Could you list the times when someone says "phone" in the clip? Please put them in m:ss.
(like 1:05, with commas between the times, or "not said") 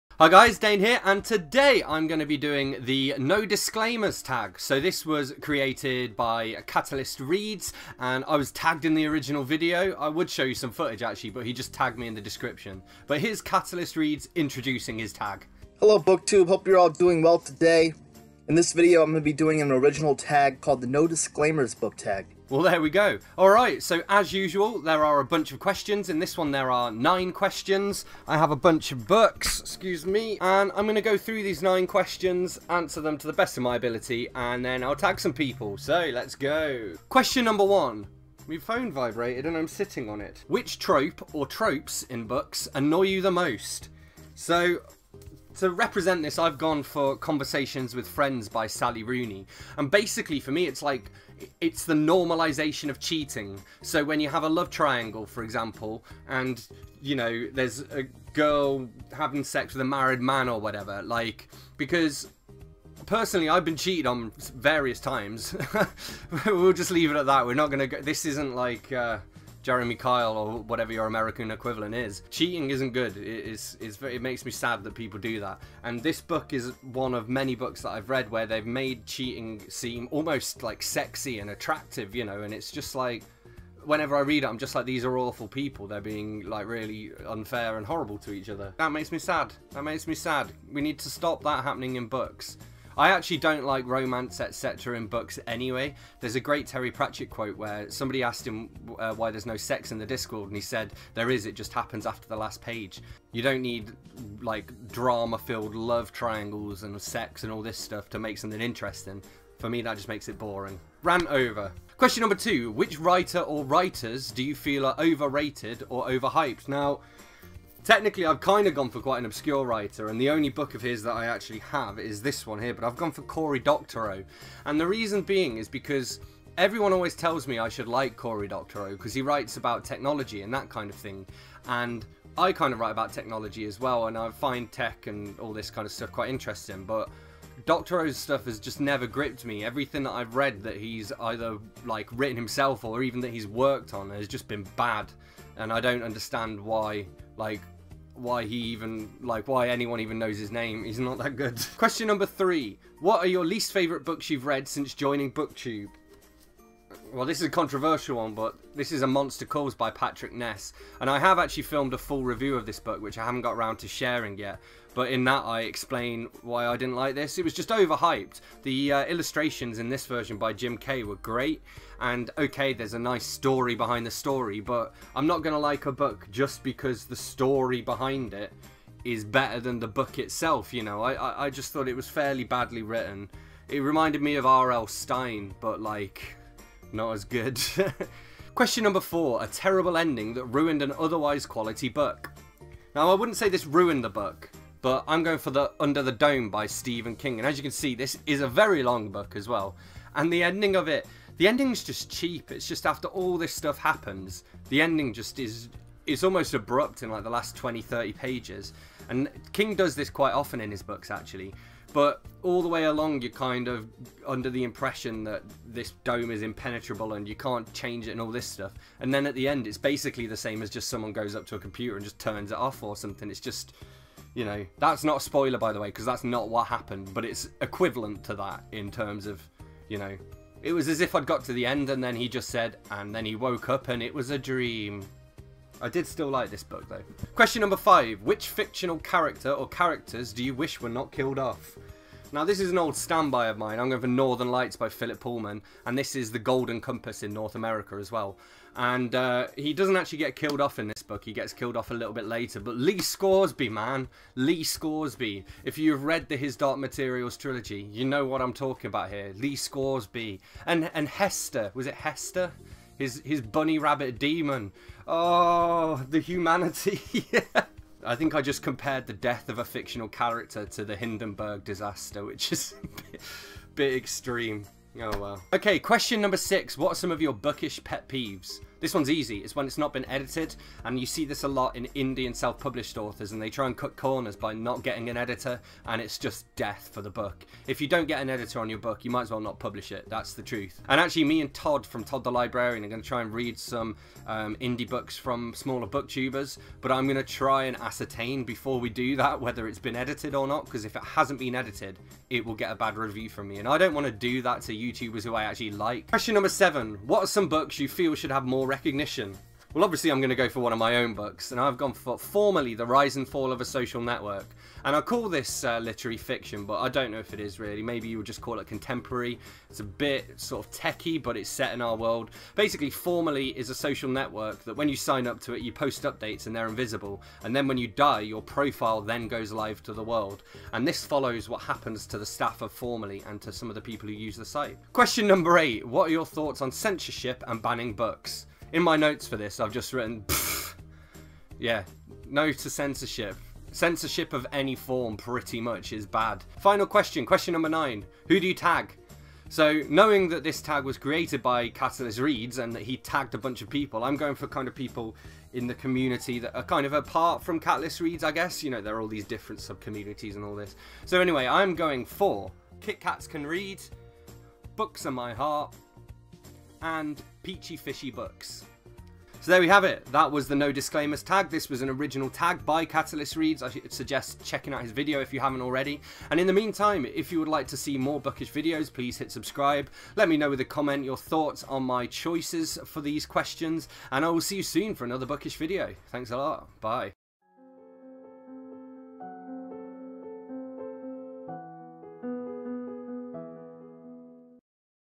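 0:38.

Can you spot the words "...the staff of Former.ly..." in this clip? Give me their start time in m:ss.
5:32.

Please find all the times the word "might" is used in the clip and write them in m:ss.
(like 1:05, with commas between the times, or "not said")
4:49.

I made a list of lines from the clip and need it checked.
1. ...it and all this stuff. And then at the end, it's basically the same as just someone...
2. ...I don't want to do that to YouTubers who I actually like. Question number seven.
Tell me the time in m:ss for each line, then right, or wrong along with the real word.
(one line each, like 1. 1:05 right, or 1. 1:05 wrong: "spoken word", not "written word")
1. 3:38 right
2. 5:03 right.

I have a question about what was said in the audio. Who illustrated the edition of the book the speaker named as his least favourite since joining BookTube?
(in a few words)
Jim Kay.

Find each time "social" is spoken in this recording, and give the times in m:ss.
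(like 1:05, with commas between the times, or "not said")
5:13, 5:23.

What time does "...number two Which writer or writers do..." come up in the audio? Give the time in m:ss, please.
1:52.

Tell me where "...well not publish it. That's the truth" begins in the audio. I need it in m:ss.
4:49.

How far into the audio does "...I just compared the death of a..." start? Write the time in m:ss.
4:28.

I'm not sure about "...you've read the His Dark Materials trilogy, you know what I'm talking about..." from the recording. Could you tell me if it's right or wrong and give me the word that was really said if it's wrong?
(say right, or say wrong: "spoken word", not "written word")
right.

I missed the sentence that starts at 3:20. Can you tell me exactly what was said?
And the ending of it, the ending's just cheap.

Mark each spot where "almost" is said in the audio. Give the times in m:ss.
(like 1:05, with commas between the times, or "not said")
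1:20, 3:26.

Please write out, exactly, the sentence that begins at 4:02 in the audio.
Now this is an old standby of mine.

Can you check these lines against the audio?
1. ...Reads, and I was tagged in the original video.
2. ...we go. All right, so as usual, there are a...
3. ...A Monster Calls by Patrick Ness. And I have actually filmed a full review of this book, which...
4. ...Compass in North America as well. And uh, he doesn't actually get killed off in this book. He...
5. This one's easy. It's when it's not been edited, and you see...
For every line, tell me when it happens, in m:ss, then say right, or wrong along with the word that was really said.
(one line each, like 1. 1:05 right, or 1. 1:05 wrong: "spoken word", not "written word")
1. 0:07 right
2. 0:22 right
3. 2:39 right
4. 4:06 right
5. 4:38 right.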